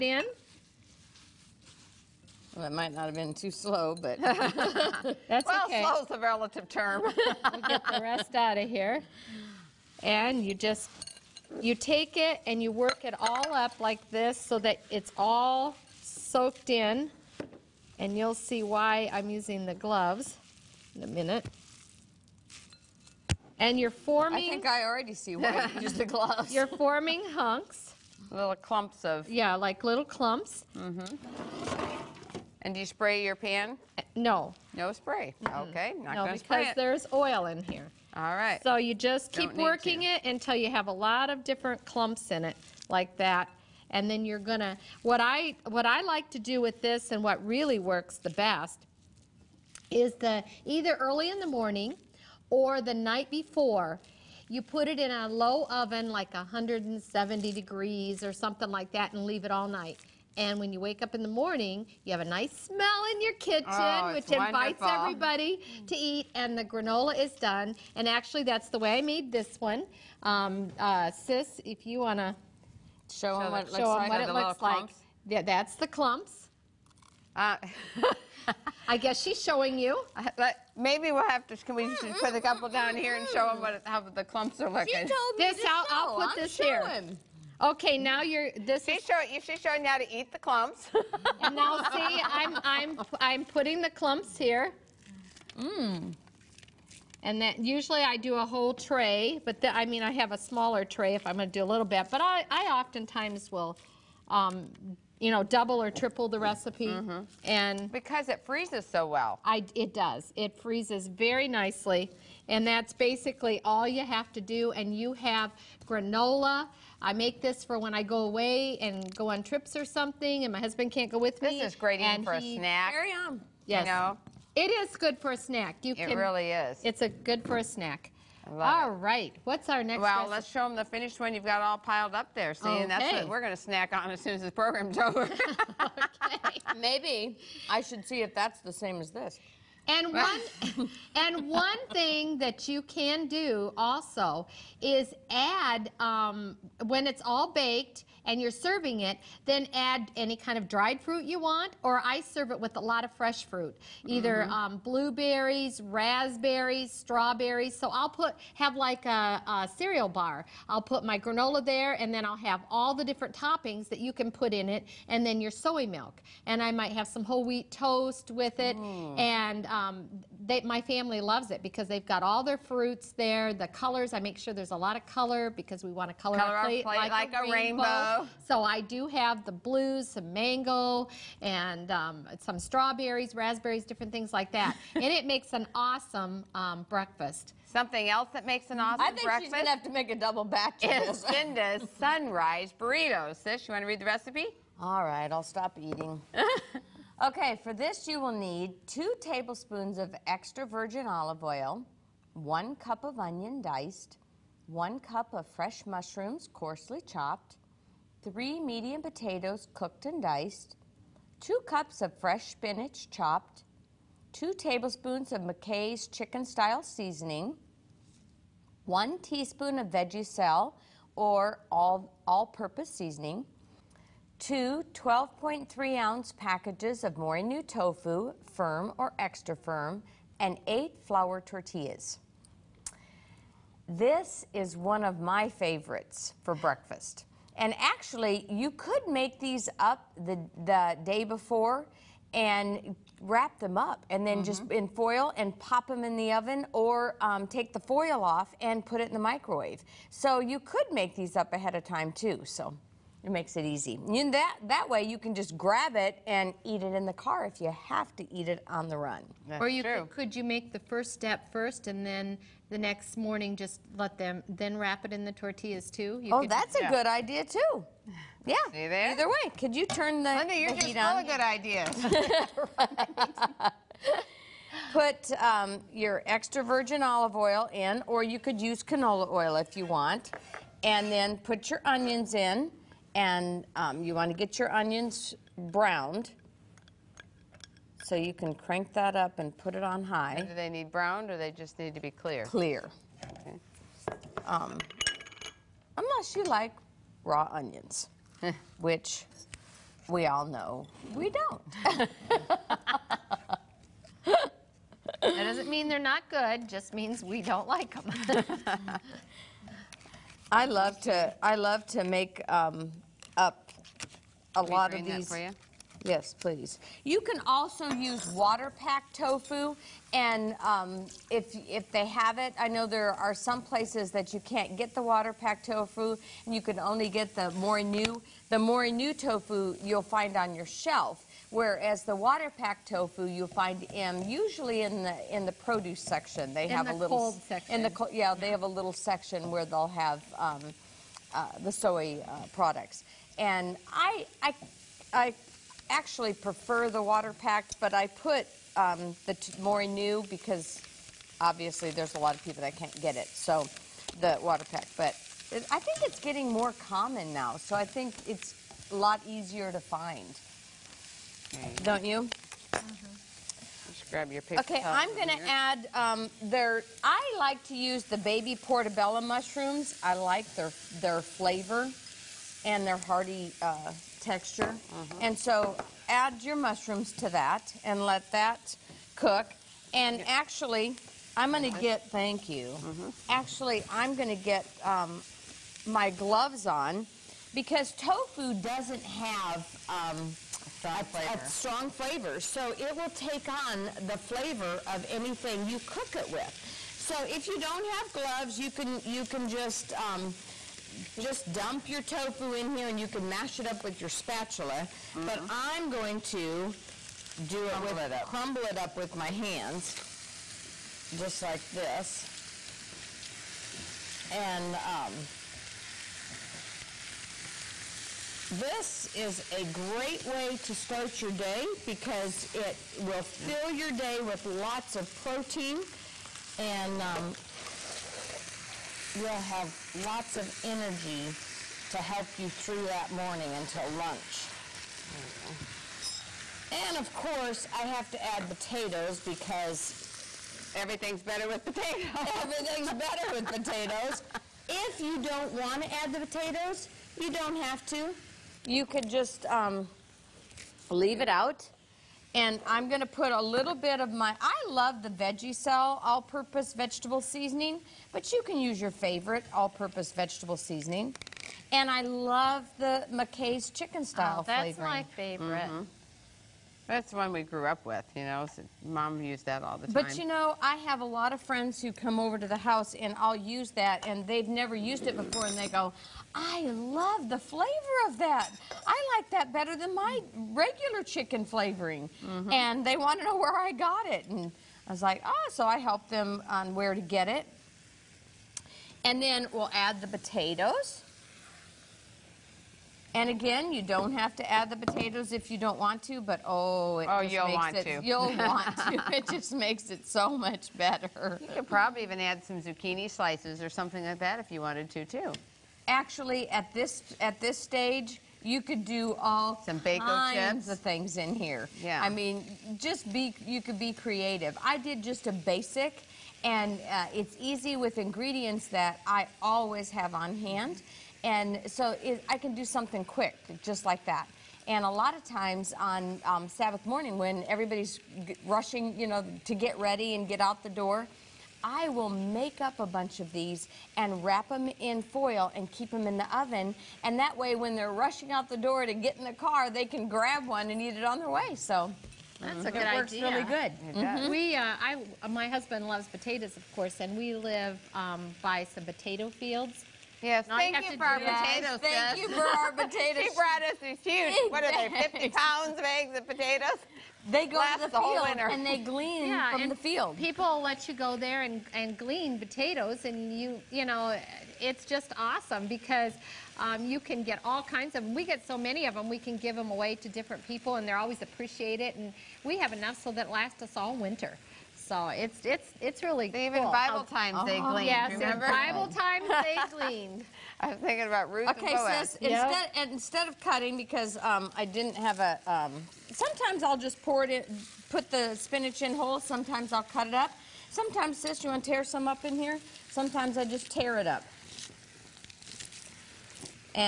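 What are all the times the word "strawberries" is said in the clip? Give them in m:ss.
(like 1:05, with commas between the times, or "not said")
2:37, 3:02.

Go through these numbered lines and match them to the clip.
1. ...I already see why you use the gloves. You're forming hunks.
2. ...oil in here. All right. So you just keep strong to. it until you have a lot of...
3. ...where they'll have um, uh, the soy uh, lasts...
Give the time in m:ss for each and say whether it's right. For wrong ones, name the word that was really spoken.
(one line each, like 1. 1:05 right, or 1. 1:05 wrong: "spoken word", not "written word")
1. 0:24 right
2. 0:37 wrong: "working", not "strong"
3. 5:39 wrong: "products", not "lasts".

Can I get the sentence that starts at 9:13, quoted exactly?
She brought us these huge, what are they, 50 pounds of eggs and potatoes?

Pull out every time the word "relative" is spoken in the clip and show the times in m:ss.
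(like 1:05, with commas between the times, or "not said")
0:06.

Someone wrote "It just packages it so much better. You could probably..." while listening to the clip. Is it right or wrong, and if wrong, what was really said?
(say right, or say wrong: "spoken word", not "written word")
wrong: "makes", not "packages".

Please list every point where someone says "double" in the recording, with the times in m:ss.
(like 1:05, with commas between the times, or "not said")
1:45, 3:10.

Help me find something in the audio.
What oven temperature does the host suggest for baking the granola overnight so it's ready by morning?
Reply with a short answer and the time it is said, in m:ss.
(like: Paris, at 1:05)
170 degrees, at 0:56.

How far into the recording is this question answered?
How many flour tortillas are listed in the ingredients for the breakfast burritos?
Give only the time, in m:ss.
3:50.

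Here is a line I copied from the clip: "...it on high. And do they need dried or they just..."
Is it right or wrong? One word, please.
wrong.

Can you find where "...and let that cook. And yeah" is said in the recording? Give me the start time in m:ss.
6:17.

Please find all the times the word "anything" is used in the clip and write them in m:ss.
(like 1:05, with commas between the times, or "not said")
6:35.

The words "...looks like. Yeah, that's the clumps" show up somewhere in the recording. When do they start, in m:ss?
1:14.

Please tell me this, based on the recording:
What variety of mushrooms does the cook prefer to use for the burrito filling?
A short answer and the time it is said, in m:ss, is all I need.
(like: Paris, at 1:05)
baby portobello, at 6:08.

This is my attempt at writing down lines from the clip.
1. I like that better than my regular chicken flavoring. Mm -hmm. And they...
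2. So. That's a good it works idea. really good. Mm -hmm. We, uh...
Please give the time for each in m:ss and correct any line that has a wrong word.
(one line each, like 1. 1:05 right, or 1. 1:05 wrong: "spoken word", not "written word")
1. 7:58 right
2. 9:01 right.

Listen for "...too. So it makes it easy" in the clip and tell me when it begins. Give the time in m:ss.
4:12.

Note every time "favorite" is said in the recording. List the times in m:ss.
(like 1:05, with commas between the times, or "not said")
3:55, 7:38, 7:45.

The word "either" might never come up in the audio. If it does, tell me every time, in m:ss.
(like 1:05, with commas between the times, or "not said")
0:50, 2:34, 4:29.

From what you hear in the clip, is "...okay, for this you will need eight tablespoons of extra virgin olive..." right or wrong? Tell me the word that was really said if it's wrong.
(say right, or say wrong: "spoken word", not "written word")
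wrong: "two", not "eight".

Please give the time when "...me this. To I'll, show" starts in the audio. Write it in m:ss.
1:25.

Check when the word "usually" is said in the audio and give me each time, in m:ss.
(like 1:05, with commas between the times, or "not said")
1:37, 5:34.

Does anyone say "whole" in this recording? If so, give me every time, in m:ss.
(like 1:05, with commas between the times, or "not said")
1:38, 2:47, 9:17, 9:48.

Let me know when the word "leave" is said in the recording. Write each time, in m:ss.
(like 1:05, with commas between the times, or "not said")
0:59, 7:30.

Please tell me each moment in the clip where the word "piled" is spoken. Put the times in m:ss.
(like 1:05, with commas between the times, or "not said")
2:11.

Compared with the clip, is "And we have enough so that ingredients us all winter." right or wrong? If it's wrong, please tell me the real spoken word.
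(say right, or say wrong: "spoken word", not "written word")
wrong: "lasts", not "ingredients".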